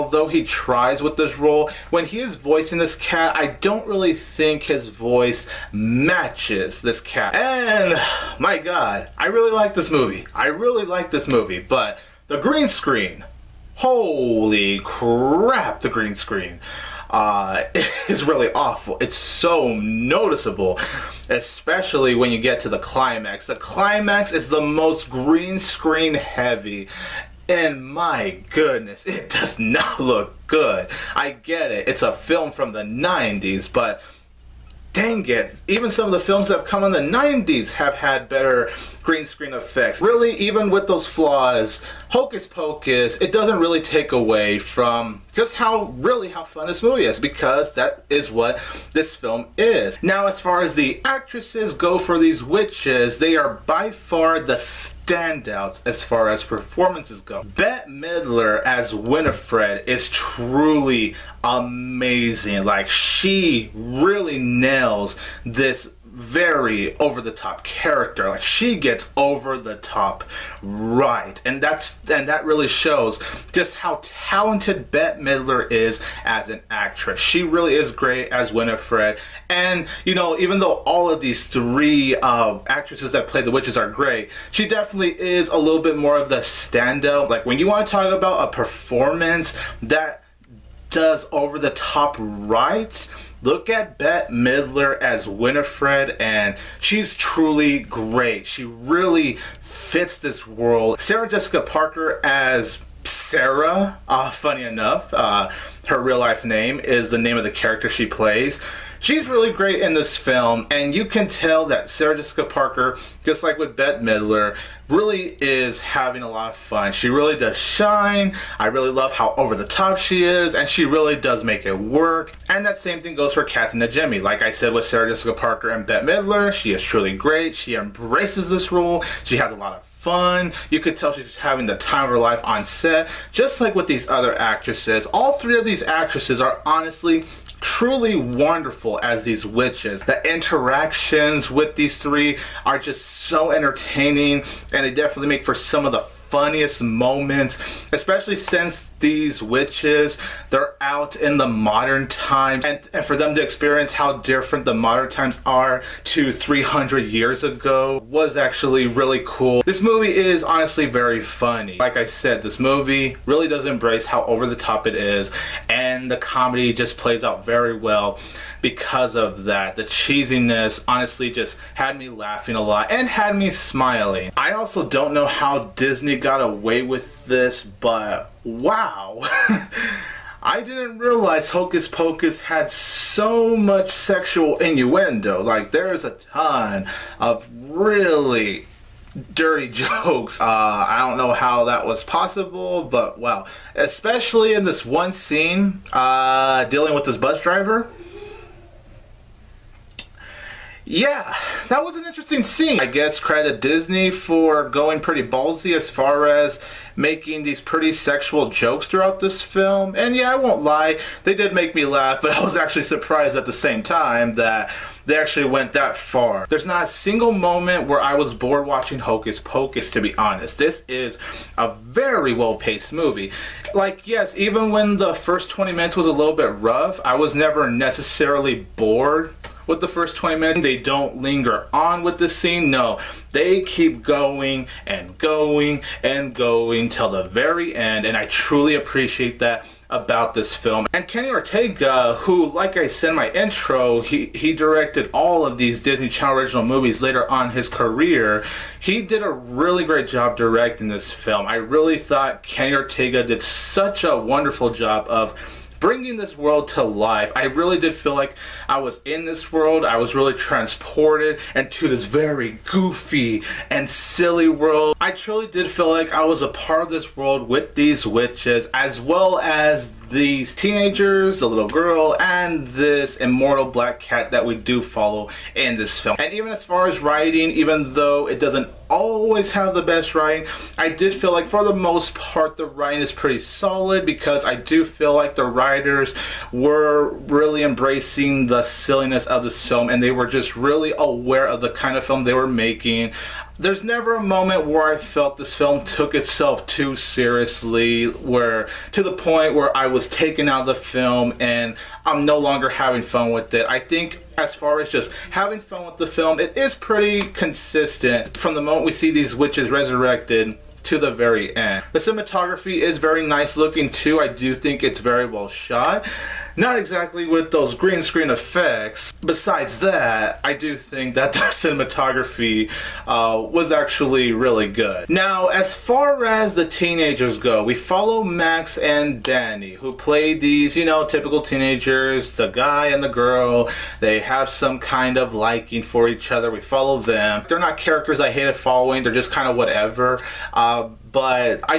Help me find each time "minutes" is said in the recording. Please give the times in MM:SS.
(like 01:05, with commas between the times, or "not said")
03:45, 03:50.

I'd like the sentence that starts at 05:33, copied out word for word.
They have some kind of liking for each other.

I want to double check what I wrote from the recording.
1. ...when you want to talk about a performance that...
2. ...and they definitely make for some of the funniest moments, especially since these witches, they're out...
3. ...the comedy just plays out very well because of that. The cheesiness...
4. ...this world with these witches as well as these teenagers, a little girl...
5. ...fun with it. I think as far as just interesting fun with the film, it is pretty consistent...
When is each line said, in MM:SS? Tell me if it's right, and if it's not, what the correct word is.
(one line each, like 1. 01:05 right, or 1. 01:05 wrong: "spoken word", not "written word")
1. 01:27 right
2. 02:24 right
3. 02:46 right
4. 04:26 right
5. 05:03 wrong: "having", not "interesting".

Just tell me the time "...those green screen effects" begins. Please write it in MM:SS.
05:17.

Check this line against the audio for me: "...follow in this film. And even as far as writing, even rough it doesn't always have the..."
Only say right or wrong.
wrong.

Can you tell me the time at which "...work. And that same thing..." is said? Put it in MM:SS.
02:01.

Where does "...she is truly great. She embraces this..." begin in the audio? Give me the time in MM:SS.
02:06.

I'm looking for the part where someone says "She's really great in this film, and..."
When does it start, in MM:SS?
01:49.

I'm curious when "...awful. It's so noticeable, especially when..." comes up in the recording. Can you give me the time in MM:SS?
00:18.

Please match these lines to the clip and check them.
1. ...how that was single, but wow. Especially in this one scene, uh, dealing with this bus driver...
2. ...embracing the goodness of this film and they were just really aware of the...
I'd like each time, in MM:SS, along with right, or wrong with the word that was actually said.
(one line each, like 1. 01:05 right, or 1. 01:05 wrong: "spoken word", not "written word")
1. 03:11 wrong: "possible", not "single"
2. 04:47 wrong: "silliness", not "goodness".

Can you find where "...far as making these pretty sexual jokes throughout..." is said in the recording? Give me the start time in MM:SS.
03:25.